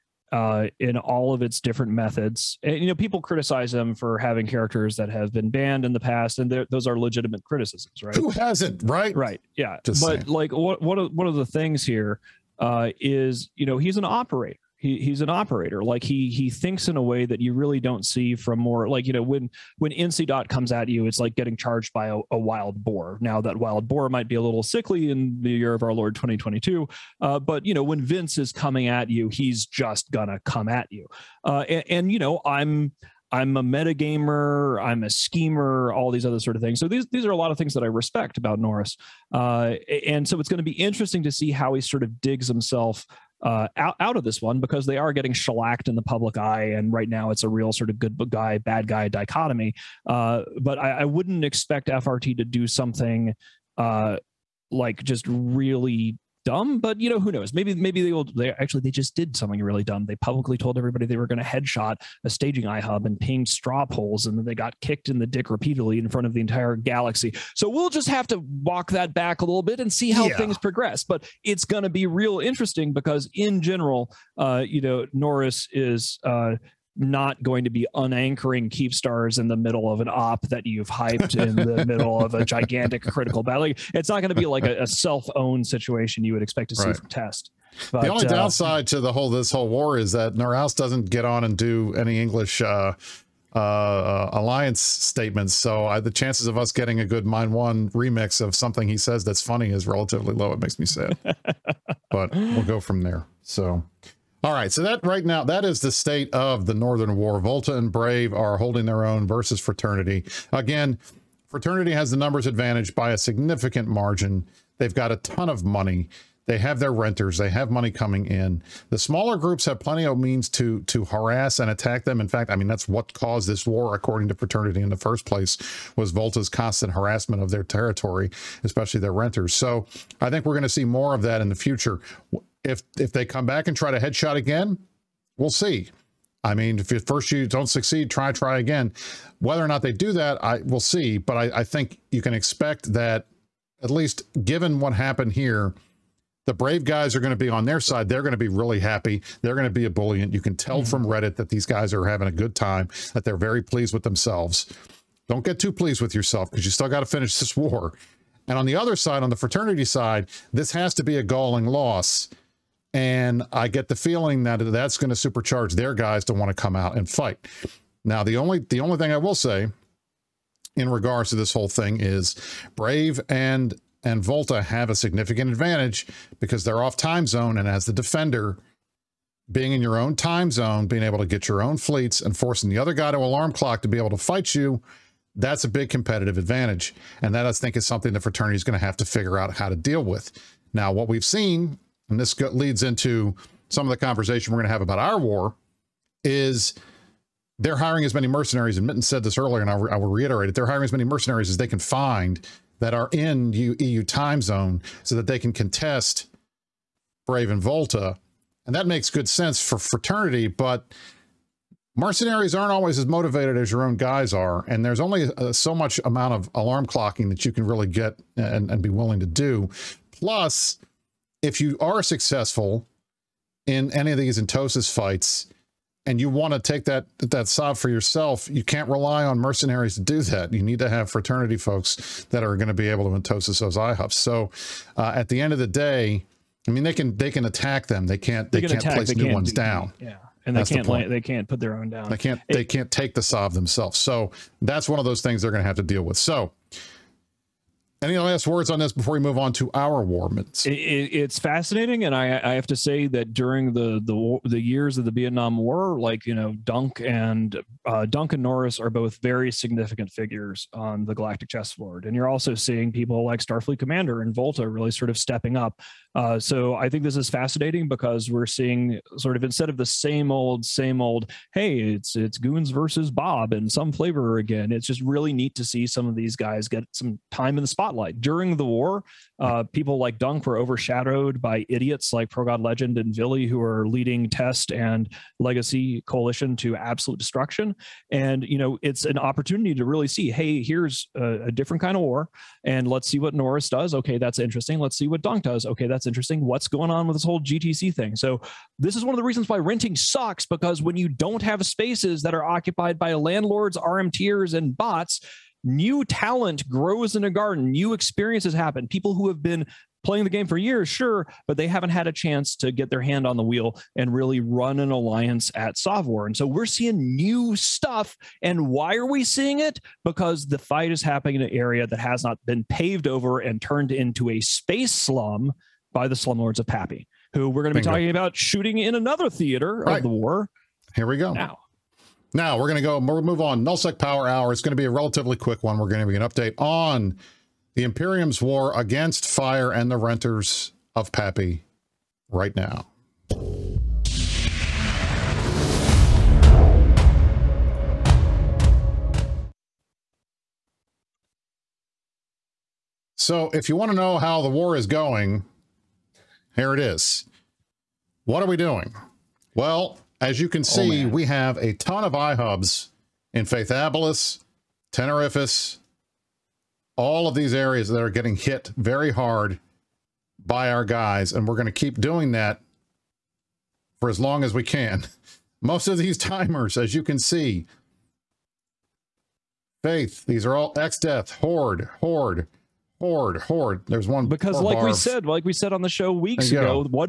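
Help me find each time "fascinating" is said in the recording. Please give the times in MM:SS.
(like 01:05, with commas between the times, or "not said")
04:11, 04:27.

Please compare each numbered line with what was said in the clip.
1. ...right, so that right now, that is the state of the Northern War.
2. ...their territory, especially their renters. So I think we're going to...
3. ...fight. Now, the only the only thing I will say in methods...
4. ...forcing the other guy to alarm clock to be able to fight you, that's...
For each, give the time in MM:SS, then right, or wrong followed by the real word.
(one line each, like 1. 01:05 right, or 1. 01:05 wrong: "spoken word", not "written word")
1. 01:44 right
2. 02:07 right
3. 02:47 wrong: "regards", not "methods"
4. 03:02 right.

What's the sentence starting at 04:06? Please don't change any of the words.
So any last words on this before we move on to our warments?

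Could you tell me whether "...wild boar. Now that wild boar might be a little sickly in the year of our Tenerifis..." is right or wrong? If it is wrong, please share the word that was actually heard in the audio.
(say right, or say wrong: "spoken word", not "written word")
wrong: "Lord", not "Tenerifis".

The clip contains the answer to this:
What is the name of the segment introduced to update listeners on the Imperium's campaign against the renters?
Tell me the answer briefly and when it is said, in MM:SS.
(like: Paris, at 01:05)
NullSec Power Hour, at 05:33.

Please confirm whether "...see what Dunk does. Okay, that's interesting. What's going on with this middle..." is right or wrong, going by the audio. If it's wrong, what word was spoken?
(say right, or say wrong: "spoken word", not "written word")
wrong: "whole", not "middle".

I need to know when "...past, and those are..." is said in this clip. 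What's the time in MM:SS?
00:06.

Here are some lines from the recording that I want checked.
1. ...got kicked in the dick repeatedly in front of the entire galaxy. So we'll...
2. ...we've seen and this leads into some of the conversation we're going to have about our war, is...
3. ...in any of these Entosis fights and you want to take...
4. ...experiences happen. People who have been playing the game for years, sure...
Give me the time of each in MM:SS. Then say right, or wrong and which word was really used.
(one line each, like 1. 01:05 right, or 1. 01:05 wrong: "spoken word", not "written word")
1. 01:04 right
2. 03:11 right
3. 03:43 right
4. 05:07 right.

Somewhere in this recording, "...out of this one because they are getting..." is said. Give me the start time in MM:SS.
00:44.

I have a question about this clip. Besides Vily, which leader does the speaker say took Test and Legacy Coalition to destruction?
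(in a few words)
Progodlegend.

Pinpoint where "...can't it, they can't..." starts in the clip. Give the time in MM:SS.
04:02.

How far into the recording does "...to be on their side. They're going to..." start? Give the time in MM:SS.
02:27.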